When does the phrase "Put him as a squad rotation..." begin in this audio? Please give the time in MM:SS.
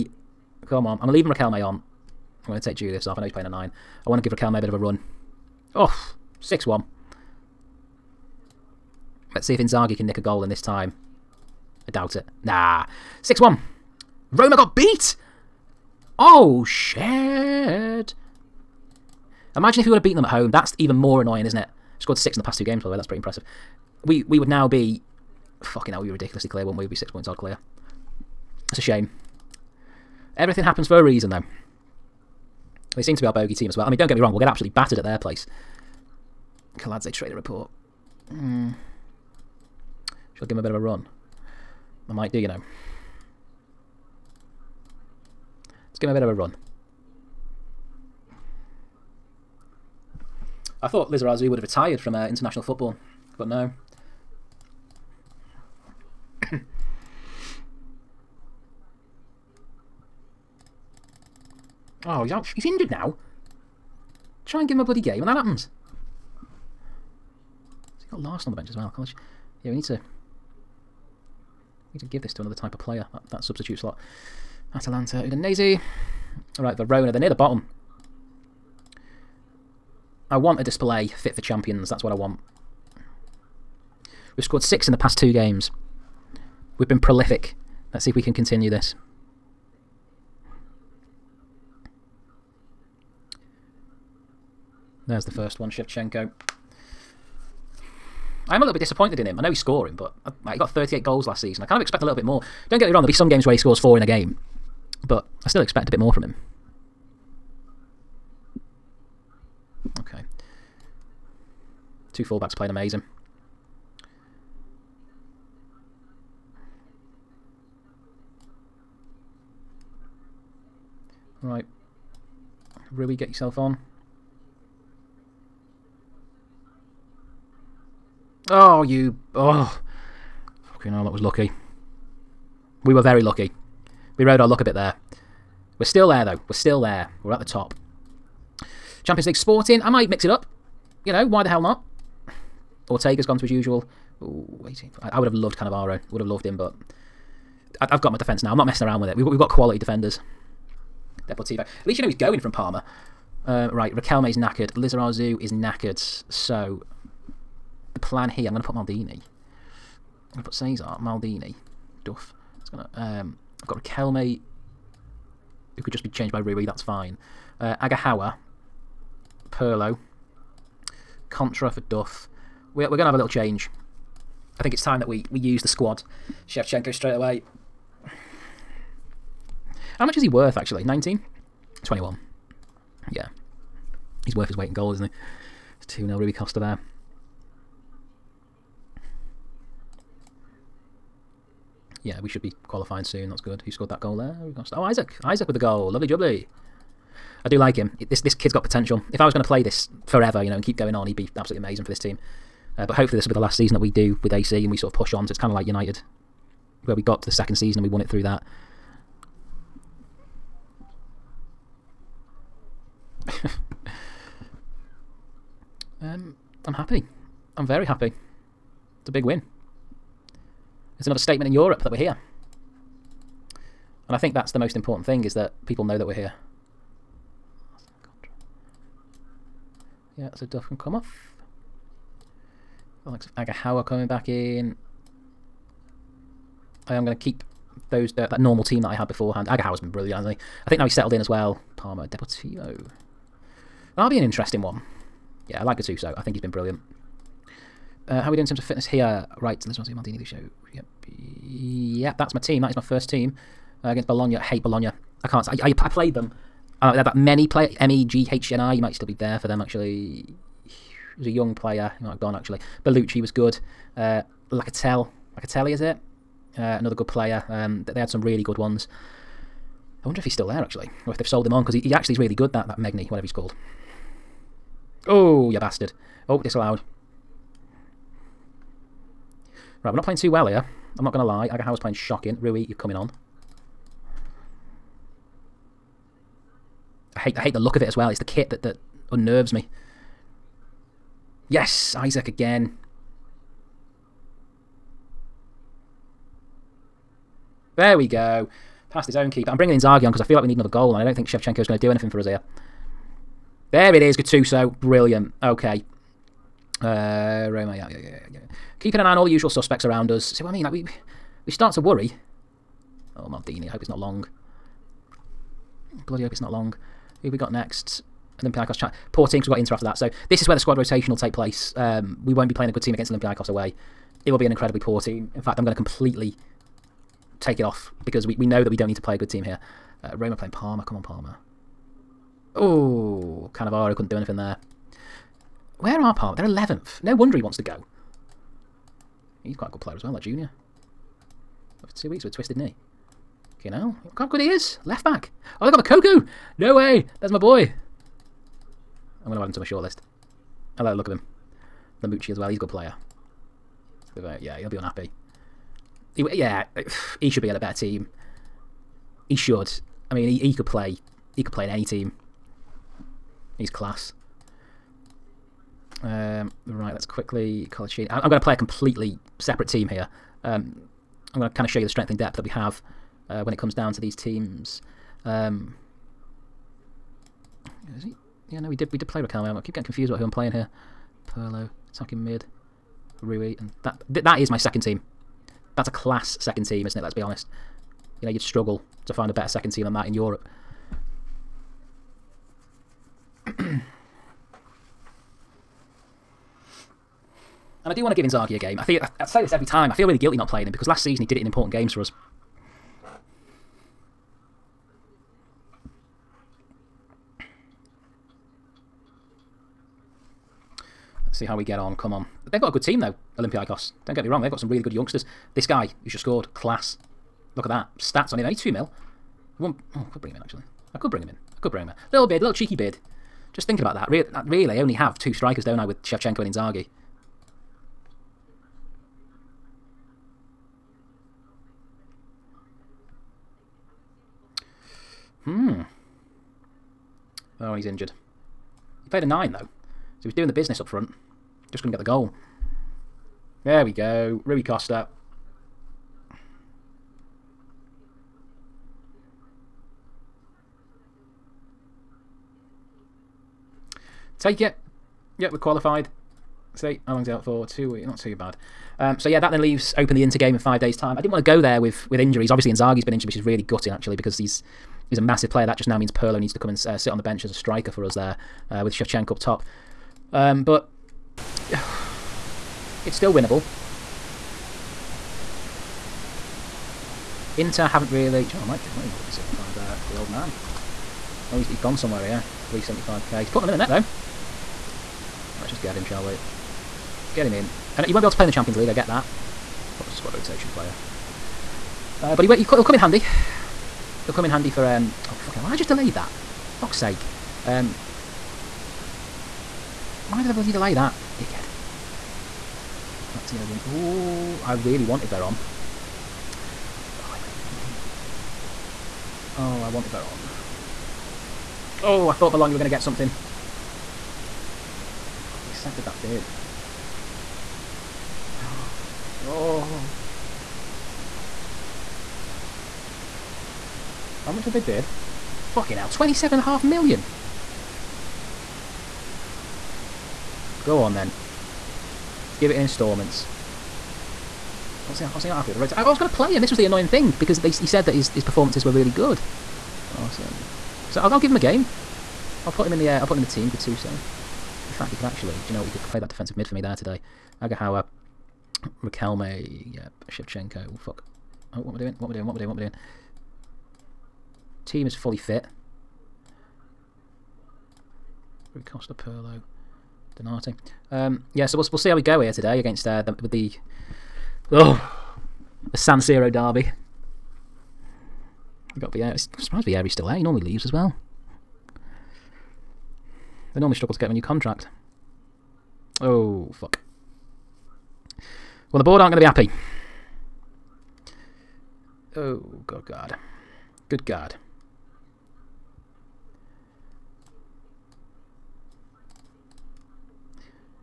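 08:09.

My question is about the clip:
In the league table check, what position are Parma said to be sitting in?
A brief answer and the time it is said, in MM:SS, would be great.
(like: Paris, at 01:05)
11th, at 05:36.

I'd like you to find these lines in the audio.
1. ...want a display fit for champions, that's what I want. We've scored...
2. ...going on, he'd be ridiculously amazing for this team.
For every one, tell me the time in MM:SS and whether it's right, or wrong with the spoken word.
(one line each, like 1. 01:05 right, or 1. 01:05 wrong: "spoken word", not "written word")
1. 01:20 right
2. 03:20 wrong: "absolutely", not "ridiculously".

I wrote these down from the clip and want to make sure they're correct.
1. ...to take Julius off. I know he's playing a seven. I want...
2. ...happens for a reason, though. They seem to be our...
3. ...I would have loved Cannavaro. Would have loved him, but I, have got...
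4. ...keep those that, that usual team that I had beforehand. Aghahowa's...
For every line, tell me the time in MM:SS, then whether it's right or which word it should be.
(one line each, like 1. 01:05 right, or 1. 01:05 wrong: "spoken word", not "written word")
1. 00:02 wrong: "nine", not "seven"
2. 00:30 right
3. 02:25 right
4. 03:57 wrong: "normal", not "usual".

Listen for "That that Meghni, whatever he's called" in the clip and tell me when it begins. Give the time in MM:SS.
04:32.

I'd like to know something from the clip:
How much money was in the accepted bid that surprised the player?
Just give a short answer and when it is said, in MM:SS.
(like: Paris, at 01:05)
27.5 million, at 08:46.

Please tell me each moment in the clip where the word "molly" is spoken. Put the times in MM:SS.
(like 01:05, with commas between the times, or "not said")
not said.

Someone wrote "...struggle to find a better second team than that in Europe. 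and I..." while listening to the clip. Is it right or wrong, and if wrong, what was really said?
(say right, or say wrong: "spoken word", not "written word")
right.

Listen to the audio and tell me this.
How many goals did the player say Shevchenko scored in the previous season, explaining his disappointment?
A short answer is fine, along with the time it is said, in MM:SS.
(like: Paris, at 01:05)
38, at 01:40.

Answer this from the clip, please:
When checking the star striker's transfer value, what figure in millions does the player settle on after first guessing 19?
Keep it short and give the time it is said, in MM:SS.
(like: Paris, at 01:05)
21, at 03:01.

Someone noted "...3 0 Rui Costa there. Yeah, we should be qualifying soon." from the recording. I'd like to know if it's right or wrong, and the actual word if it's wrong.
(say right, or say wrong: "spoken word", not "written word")
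wrong: "2", not "3".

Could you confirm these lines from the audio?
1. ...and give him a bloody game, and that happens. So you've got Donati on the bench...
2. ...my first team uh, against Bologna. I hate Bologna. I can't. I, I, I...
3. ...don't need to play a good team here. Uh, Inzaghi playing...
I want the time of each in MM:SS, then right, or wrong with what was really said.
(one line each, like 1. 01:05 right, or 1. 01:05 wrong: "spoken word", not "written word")
1. 01:04 wrong: "Laursen", not "Donati"
2. 04:12 right
3. 05:28 wrong: "Roma", not "Inzaghi".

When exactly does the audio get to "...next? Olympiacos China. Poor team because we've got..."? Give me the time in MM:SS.
05:17.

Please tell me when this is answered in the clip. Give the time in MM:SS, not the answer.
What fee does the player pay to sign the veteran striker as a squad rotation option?
08:02.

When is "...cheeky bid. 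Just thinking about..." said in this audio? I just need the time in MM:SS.
07:02.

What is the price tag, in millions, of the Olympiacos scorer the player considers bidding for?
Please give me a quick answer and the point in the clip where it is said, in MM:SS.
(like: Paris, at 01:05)
2 million, at 06:58.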